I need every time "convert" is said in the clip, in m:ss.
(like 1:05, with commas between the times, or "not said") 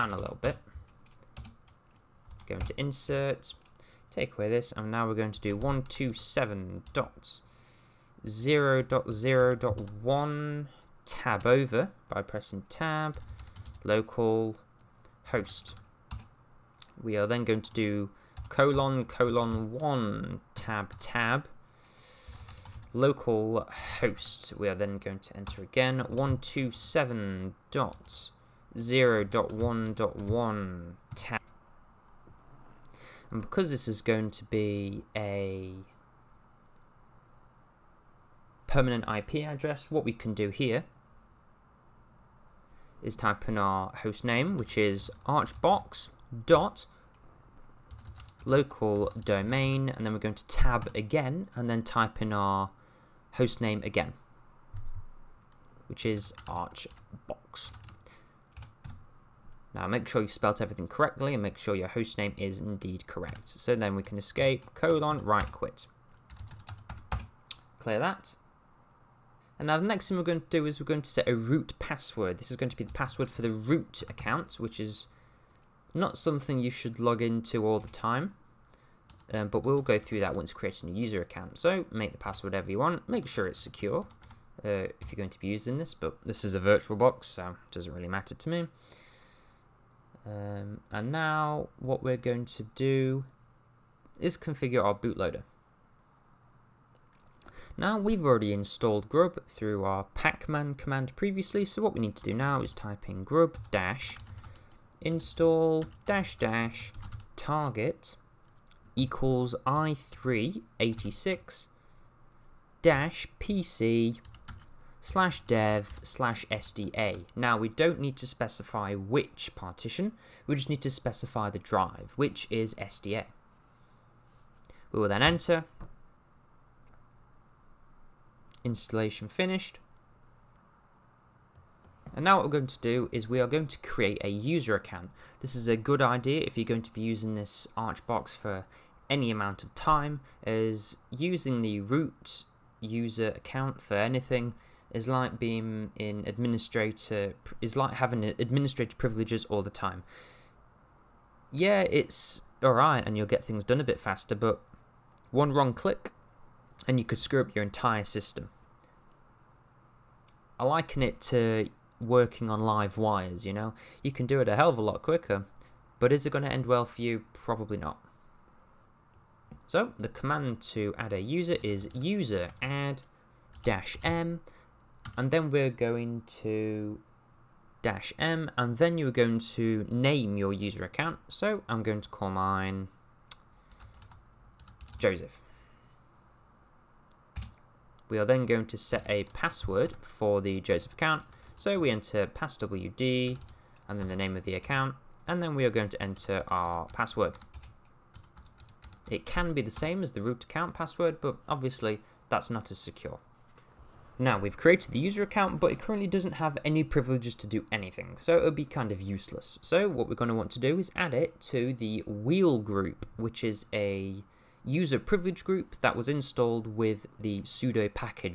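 not said.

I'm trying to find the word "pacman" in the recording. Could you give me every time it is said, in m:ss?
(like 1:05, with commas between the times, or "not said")
1:40.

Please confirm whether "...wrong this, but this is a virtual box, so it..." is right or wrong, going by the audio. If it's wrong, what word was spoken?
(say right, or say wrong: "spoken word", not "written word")
wrong: "using", not "wrong".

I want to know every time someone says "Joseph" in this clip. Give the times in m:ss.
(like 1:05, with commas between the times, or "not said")
3:04, 3:10.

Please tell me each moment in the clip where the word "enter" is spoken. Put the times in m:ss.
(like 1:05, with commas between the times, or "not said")
0:25, 2:05, 3:11, 3:15.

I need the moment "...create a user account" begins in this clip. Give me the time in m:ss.
2:13.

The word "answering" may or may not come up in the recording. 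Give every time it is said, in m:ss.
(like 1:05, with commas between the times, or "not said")
not said.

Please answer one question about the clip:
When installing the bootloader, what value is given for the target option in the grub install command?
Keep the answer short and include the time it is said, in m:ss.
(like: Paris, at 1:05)
i386-pc, at 1:49.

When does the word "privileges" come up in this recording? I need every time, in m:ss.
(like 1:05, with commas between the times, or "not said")
2:28, 3:26, 3:34.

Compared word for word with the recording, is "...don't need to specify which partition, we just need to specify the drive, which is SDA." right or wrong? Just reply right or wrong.
right.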